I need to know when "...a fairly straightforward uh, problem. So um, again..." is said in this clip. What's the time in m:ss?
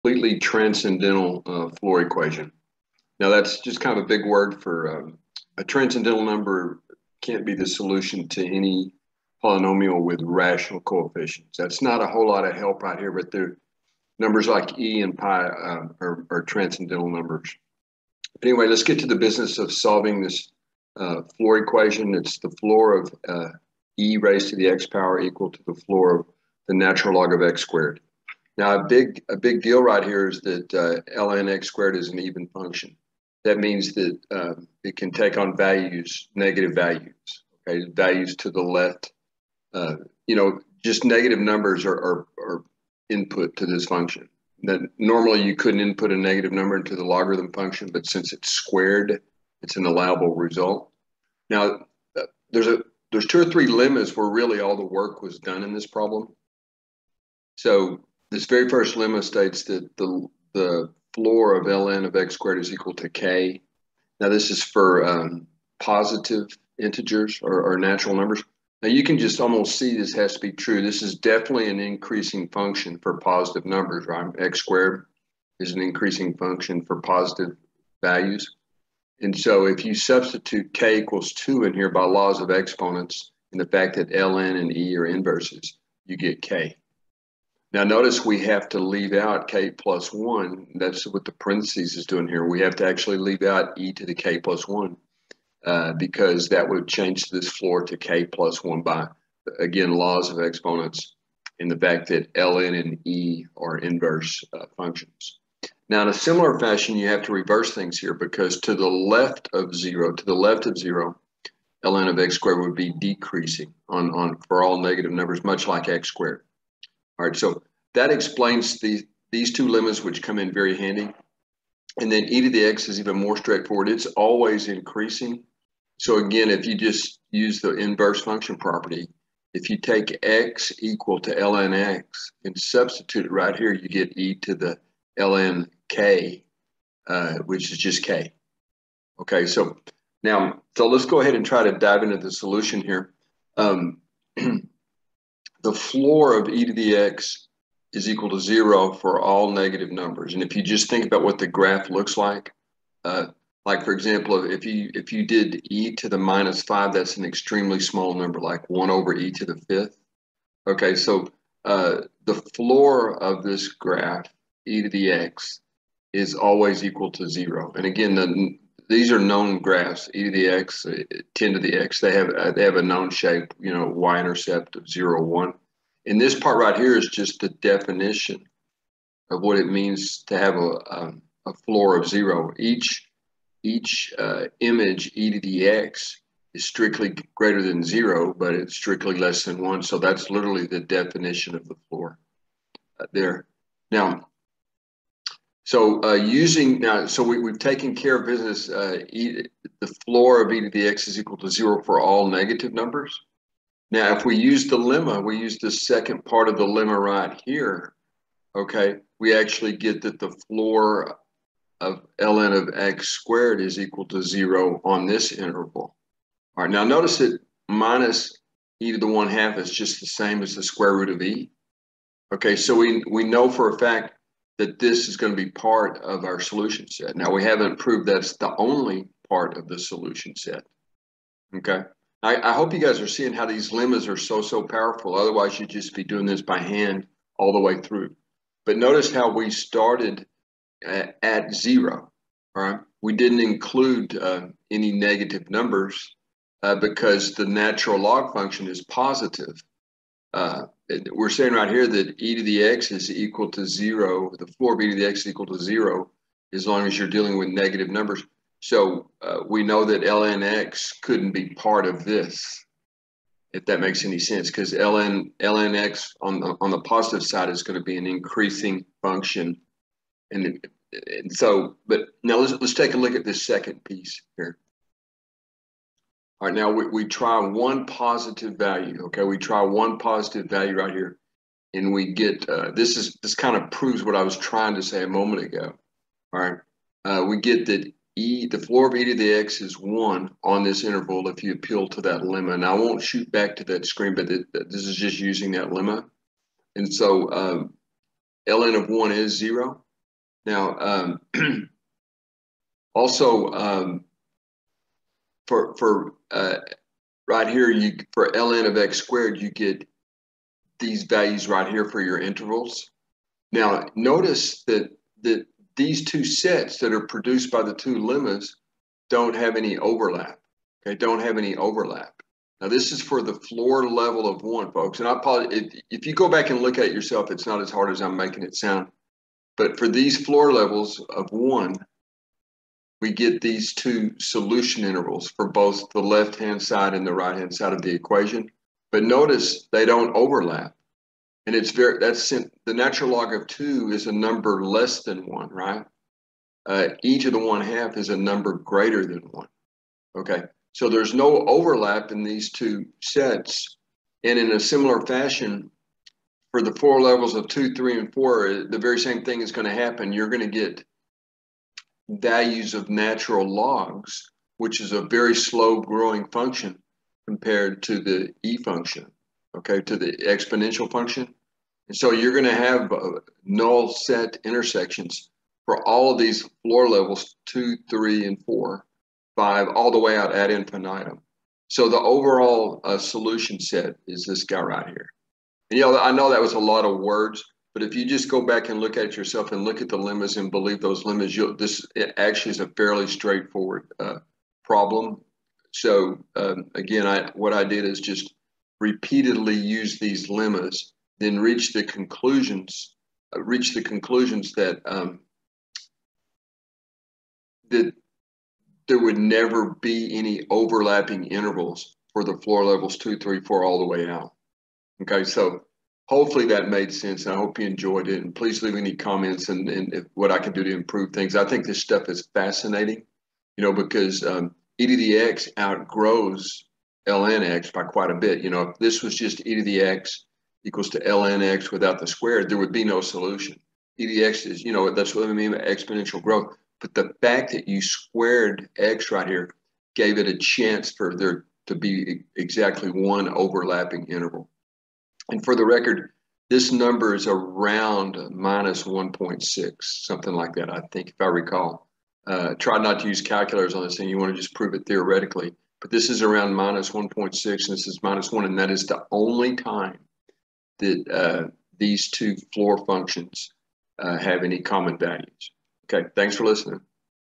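6:32.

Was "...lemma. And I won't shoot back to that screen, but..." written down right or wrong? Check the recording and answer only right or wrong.
right.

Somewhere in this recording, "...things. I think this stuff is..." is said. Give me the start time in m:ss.
7:01.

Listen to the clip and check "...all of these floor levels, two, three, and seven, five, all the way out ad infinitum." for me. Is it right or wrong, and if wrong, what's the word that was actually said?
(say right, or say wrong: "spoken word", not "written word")
wrong: "four", not "seven".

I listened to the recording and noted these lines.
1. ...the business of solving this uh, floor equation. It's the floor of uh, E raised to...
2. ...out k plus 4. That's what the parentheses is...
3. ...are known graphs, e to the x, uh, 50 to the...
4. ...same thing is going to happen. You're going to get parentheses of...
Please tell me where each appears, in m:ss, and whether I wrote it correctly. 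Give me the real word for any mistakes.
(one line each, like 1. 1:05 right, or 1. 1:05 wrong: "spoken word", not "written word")
1. 0:19 right
2. 1:29 wrong: "1", not "4"
3. 2:49 wrong: "10", not "50"
4. 5:58 wrong: "values", not "parentheses".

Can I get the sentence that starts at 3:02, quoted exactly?
Each, each uh, image, e to the x, is strictly greater than 0, but it's strictly less than 1.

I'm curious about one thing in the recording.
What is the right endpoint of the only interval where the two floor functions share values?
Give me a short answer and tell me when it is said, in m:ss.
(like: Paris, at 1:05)
-1, at 7:38.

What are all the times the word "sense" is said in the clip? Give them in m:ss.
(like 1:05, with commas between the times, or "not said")
4:24, 6:56.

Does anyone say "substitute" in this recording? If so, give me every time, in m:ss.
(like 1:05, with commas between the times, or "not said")
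1:19, 2:12.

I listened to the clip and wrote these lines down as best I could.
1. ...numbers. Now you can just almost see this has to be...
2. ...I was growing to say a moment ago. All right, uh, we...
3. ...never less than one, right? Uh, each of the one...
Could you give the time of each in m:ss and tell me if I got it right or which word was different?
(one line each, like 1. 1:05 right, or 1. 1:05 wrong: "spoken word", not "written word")
1. 1:08 right
2. 4:44 wrong: "trying", not "growing"
3. 5:44 wrong: "number", not "never".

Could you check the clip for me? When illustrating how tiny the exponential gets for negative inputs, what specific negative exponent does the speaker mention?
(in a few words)
-5.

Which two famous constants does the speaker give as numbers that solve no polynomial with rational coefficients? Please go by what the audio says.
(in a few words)
e and pi.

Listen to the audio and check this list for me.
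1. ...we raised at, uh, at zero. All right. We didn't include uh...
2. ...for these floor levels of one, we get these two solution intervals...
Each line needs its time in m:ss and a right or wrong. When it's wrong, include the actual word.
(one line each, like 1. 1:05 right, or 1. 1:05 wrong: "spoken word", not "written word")
1. 3:59 wrong: "started", not "raised"
2. 5:29 right.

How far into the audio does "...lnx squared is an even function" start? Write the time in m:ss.
0:31.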